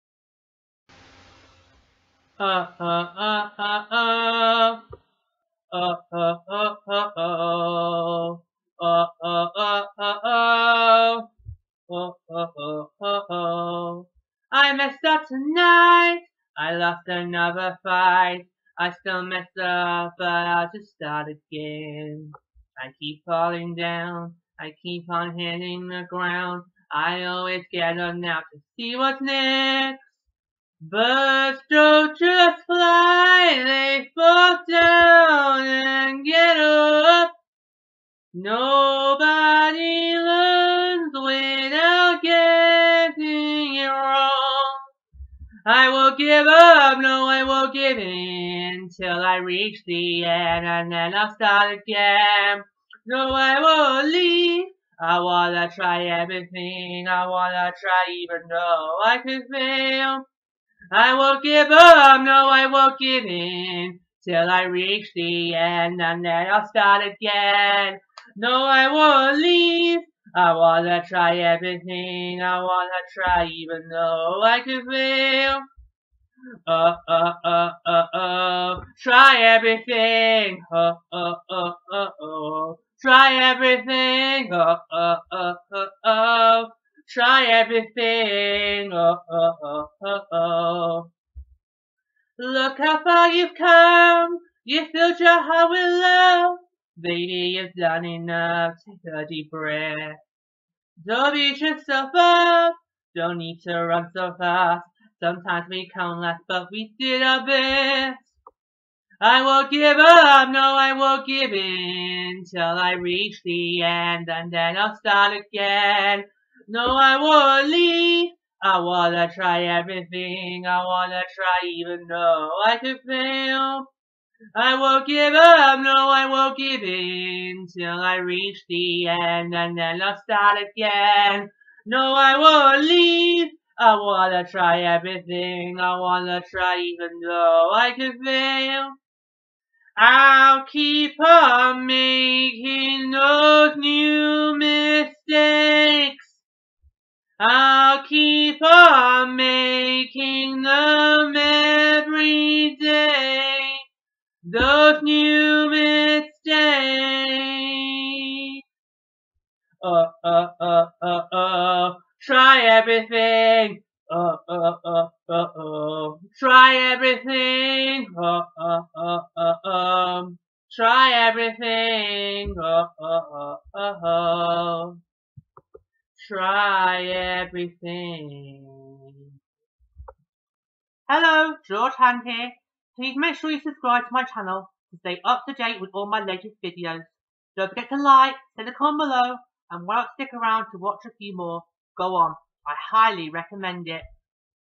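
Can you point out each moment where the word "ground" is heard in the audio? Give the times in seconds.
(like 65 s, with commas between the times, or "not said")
26 s.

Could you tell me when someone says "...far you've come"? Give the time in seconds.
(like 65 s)
93 s.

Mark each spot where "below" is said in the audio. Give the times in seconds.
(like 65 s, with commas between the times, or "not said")
189 s.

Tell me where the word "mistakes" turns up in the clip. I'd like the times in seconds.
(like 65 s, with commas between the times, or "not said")
144 s, 155 s.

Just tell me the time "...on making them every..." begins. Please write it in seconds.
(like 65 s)
148 s.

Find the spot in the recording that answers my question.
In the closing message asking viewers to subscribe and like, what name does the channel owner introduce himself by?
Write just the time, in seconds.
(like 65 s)
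181 s.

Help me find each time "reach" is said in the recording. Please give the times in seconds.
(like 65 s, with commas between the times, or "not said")
49 s, 64 s, 112 s, 128 s.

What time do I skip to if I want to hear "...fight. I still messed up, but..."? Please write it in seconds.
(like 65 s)
17 s.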